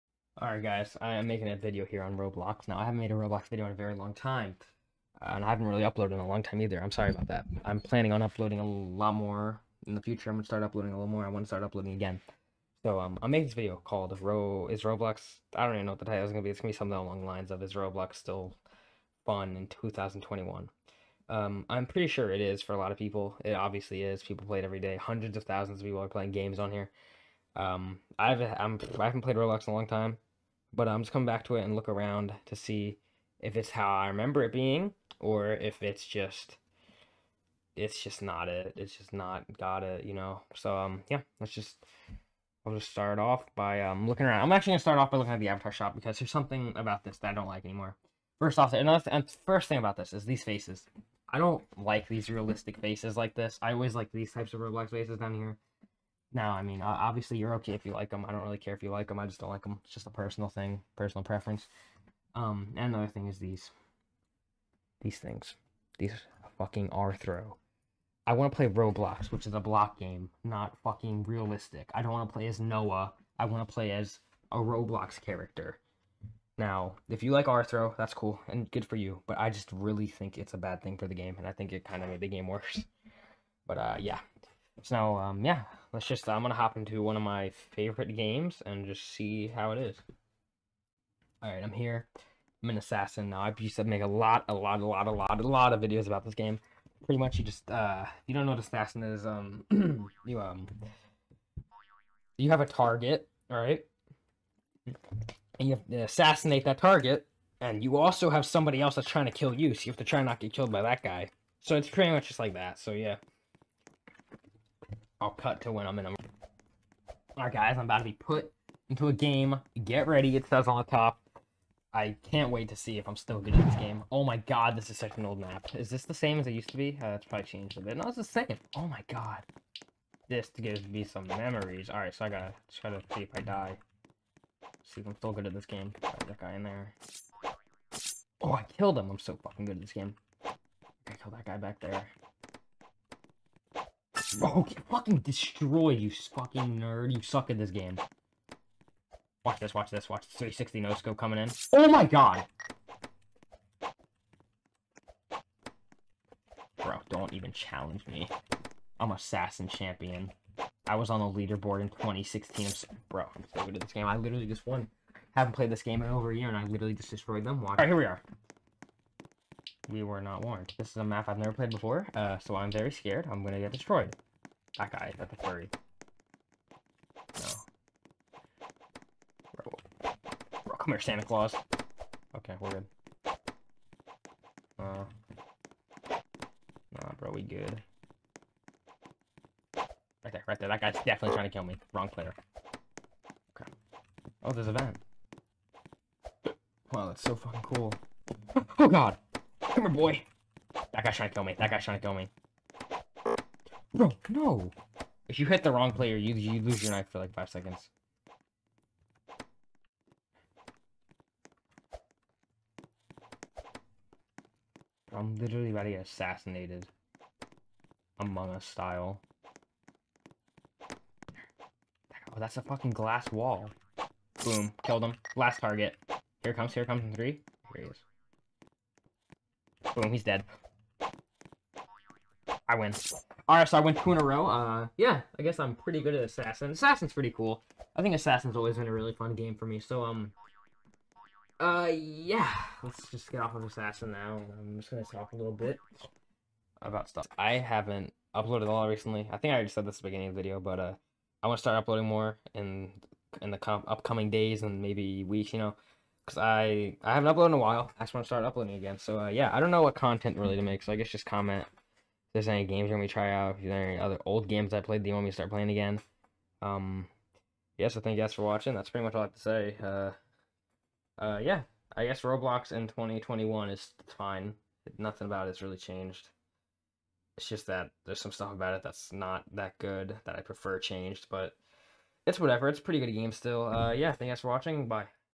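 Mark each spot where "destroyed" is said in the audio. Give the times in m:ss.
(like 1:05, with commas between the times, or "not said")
2:25, 2:47, 2:53.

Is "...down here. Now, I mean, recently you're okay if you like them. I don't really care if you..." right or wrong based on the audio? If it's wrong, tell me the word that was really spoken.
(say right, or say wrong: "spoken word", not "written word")
wrong: "obviously", not "recently".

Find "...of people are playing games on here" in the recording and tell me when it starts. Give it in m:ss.
0:25.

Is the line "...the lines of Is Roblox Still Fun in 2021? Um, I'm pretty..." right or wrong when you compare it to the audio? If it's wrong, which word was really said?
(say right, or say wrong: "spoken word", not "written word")
right.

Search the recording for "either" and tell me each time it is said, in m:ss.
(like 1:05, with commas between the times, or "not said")
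0:06.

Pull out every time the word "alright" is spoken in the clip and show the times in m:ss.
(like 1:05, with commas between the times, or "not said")
0:00, 1:31, 1:43, 1:57, 2:11, 3:53.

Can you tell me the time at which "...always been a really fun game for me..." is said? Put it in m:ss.
3:58.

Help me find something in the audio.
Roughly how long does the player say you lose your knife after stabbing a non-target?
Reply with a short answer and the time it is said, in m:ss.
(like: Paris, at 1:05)
5 seconds, at 3:27.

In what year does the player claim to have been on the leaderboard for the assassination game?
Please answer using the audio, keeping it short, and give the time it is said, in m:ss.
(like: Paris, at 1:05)
2016, at 2:41.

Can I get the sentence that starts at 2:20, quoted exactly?
I killed that guy back there.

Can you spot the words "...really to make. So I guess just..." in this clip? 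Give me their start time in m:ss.
4:20.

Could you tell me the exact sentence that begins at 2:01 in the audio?
I can't wait to see if I'm still good at this game.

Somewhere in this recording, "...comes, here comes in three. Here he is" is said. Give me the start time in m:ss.
3:46.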